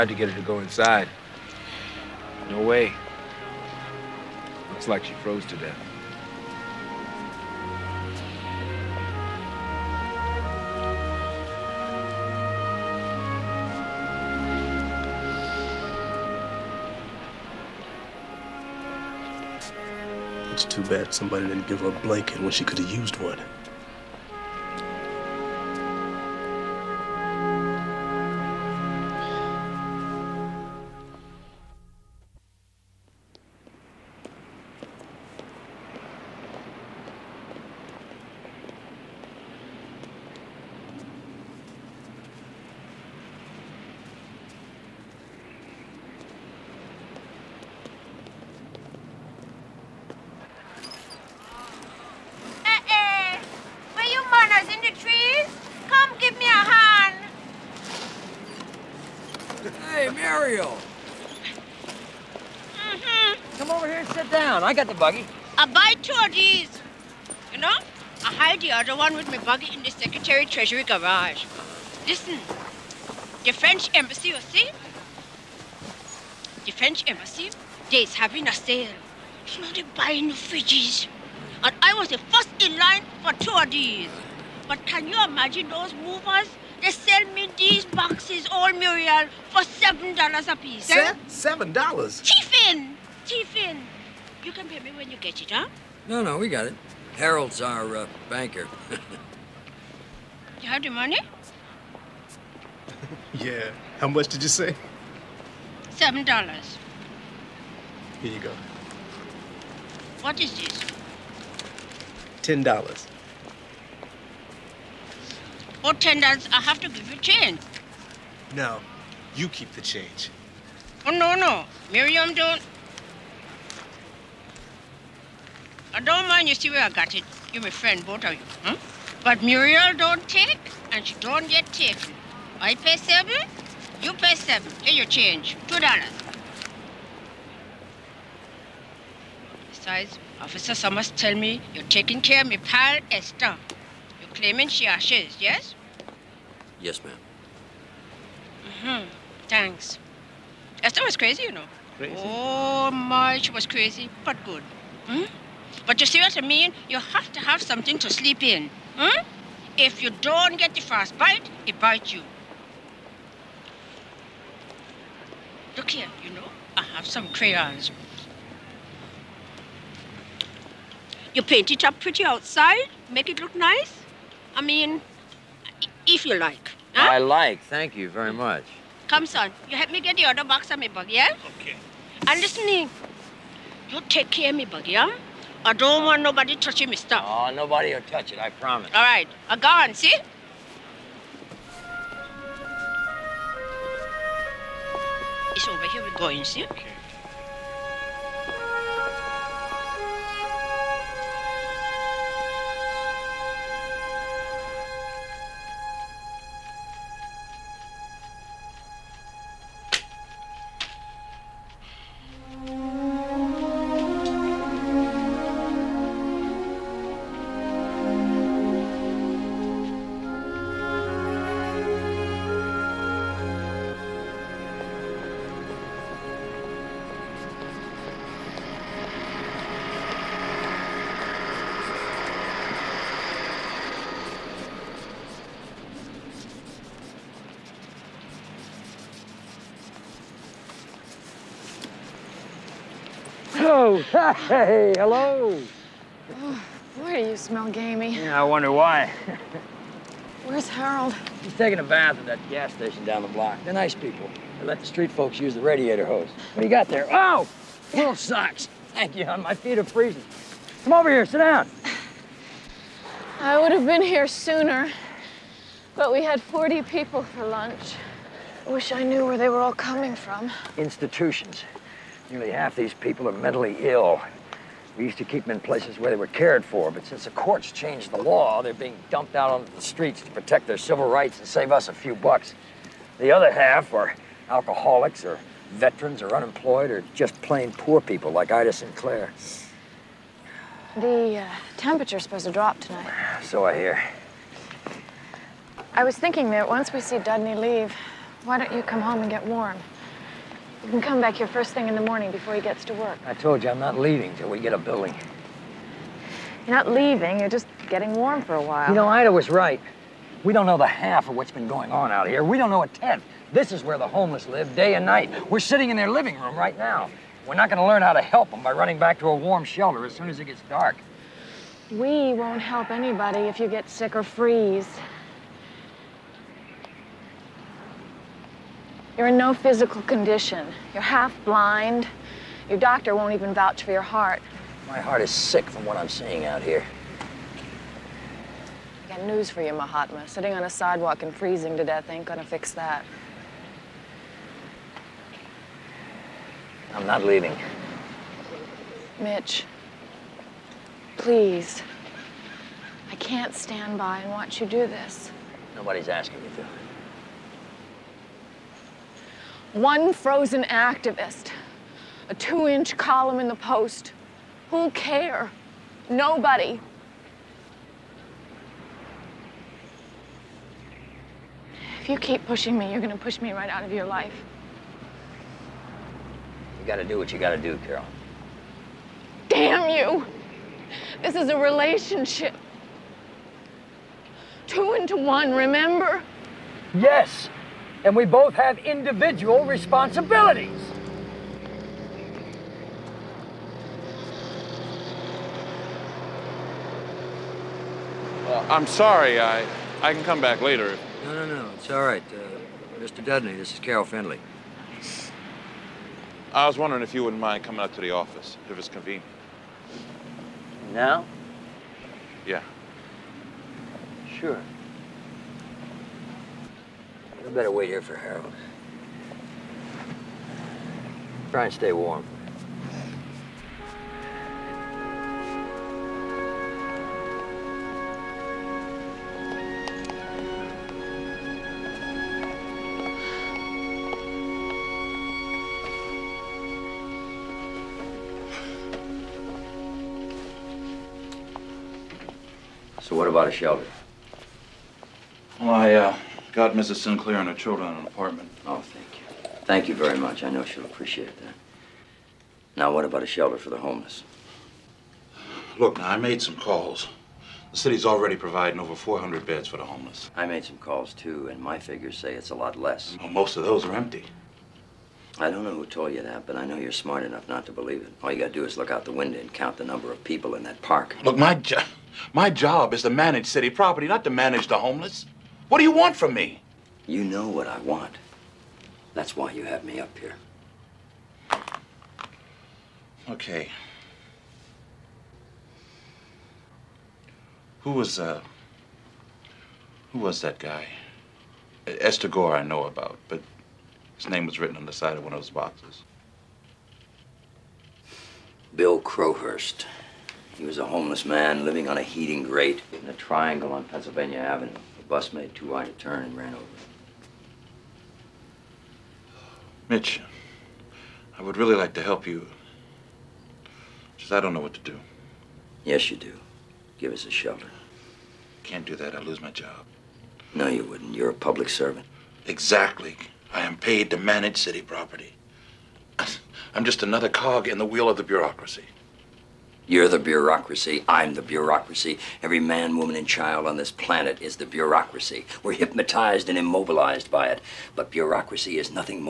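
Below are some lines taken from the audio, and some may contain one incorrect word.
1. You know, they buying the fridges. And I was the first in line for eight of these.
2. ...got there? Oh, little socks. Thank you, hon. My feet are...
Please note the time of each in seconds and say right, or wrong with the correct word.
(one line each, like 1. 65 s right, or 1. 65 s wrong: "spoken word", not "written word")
1. 79 s wrong: "two", not "eight"
2. 256 s right.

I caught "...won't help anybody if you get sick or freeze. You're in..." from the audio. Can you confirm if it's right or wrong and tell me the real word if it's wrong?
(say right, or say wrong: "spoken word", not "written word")
right.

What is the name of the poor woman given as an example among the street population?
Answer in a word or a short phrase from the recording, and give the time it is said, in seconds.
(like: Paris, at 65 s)
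Ida Sinclair, at 288 s.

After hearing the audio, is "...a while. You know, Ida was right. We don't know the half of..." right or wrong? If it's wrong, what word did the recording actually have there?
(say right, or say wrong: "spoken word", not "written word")
right.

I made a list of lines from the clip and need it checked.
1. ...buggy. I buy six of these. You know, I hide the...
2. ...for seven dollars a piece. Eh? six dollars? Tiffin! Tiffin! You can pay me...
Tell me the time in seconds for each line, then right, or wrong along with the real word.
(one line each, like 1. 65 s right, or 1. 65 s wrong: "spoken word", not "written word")
1. 64 s wrong: "two", not "six"
2. 89 s wrong: "seven", not "six".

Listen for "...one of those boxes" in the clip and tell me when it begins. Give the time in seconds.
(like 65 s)
495 s.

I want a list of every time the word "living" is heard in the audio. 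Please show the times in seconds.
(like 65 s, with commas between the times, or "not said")
316 s, 501 s.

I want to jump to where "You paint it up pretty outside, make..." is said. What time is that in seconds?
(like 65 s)
171 s.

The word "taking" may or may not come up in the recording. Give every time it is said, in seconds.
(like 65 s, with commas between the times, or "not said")
141 s, 251 s.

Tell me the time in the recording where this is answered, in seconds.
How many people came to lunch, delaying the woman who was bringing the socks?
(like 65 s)
266 s.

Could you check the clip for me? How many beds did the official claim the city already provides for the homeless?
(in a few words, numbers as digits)
400.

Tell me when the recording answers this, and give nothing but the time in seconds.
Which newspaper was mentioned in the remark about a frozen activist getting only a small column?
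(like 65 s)
363 s.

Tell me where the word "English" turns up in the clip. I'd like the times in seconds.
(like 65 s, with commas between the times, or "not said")
not said.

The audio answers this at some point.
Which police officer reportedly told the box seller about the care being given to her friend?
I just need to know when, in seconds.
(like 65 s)
140 s.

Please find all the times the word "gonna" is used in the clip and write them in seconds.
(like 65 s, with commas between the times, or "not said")
342 s, 373 s.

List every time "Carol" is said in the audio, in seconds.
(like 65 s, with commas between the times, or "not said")
377 s, 403 s.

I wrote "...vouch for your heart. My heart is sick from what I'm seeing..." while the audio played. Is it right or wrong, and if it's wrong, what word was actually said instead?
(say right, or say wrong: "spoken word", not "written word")
right.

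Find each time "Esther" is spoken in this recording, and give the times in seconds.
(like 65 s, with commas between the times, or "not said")
143 s, 150 s, 491 s.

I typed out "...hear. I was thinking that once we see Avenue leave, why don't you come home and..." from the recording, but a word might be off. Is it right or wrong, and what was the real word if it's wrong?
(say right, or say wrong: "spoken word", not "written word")
wrong: "Dudney", not "Avenue".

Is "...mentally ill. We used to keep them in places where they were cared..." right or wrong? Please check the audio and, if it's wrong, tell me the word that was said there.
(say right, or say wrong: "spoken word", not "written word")
right.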